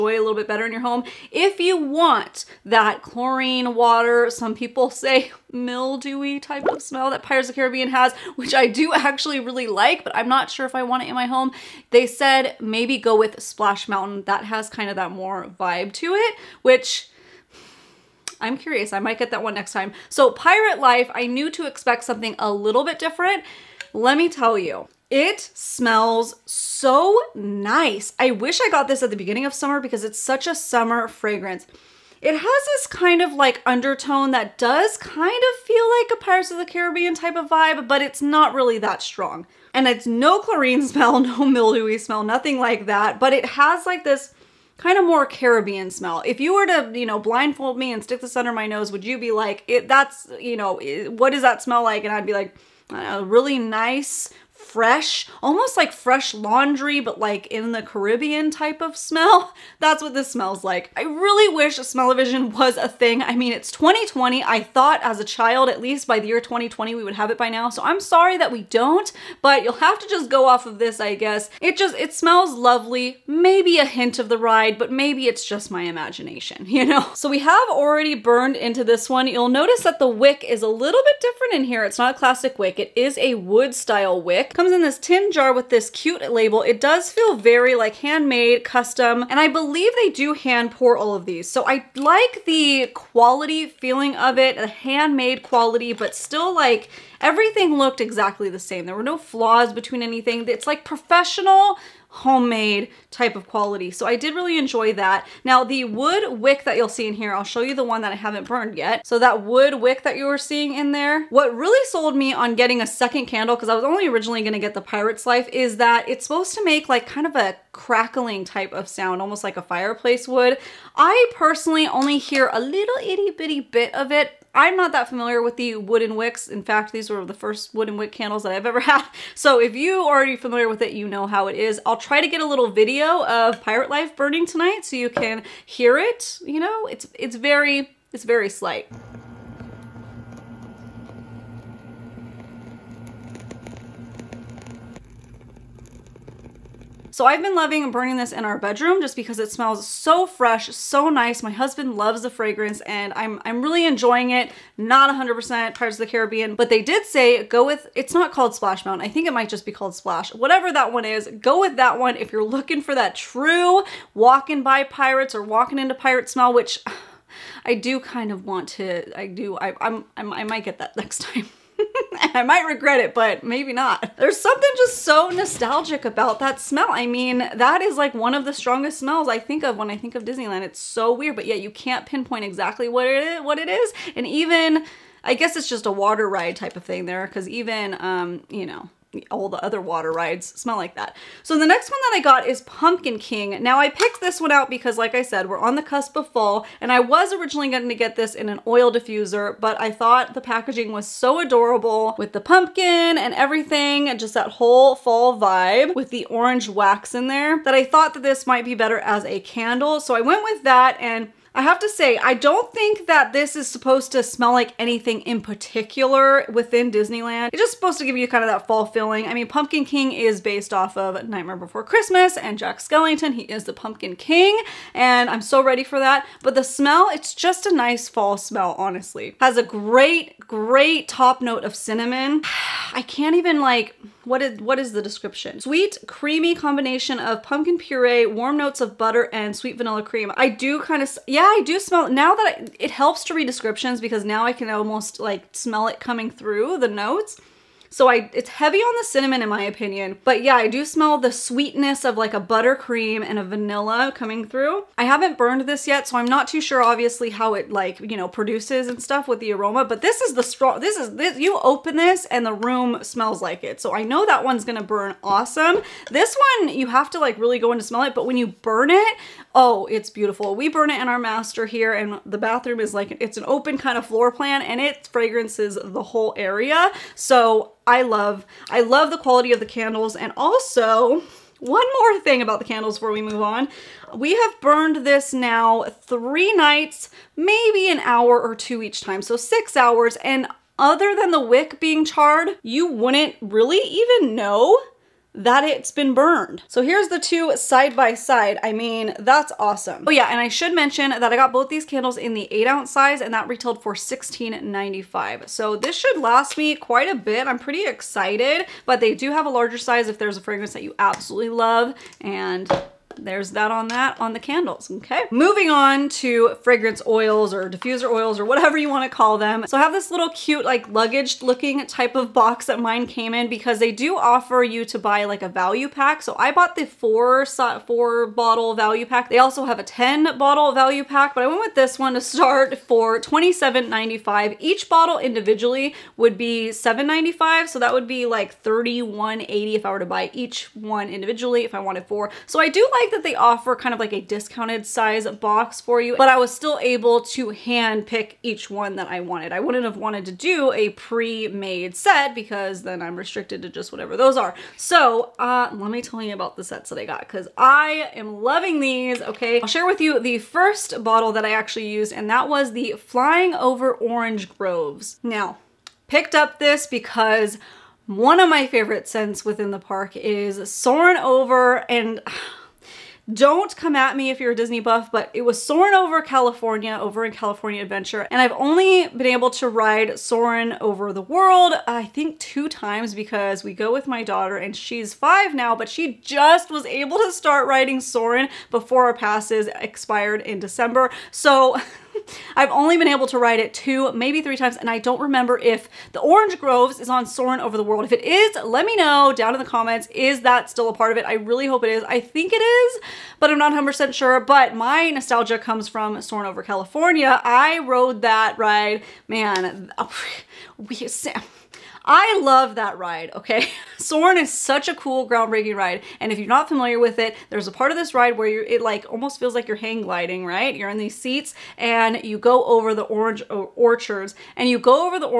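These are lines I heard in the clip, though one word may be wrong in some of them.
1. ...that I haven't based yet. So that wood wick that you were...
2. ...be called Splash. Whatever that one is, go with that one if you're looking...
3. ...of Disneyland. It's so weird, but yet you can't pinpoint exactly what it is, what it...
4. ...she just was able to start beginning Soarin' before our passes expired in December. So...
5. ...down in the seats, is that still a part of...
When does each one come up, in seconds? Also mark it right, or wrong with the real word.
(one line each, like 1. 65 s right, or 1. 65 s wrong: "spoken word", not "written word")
1. 108 s wrong: "burned", not "based"
2. 159 s right
3. 180 s right
4. 385 s wrong: "riding", not "beginning"
5. 399 s wrong: "comments", not "seats".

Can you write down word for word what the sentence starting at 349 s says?
I wouldn't have wanted to do a pre-made set because then I'm restricted to just whatever those are.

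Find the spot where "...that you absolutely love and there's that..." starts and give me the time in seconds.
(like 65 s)
310 s.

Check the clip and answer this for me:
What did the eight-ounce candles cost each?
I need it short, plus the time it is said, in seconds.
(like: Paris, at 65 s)
$16.95, at 303 s.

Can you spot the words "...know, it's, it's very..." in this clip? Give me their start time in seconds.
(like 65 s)
136 s.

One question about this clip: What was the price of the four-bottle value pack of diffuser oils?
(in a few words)
$27.95.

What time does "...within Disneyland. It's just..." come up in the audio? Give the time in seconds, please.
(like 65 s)
216 s.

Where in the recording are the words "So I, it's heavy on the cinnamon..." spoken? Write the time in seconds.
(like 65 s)
247 s.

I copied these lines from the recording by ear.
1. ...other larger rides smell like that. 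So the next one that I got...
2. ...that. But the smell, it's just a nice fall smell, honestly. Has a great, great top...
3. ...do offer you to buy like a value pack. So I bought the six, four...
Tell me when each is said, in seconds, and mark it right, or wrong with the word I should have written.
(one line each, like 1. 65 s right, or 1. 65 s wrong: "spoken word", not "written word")
1. 189 s wrong: "water", not "larger"
2. 225 s right
3. 323 s wrong: "four", not "six".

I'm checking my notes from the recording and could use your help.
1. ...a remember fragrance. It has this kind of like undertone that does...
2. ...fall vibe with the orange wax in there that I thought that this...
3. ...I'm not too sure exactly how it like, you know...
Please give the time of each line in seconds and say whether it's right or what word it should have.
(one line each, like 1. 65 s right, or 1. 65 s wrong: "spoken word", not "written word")
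1. 30 s wrong: "summer", not "remember"
2. 204 s right
3. 256 s wrong: "obviously", not "exactly".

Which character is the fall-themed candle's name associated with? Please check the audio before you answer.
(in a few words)
Jack Skellington.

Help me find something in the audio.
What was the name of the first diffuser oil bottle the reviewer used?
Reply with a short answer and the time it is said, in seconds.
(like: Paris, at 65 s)
Flying Over Orange Groves, at 362 s.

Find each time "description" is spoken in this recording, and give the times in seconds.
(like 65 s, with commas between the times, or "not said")
235 s, 243 s.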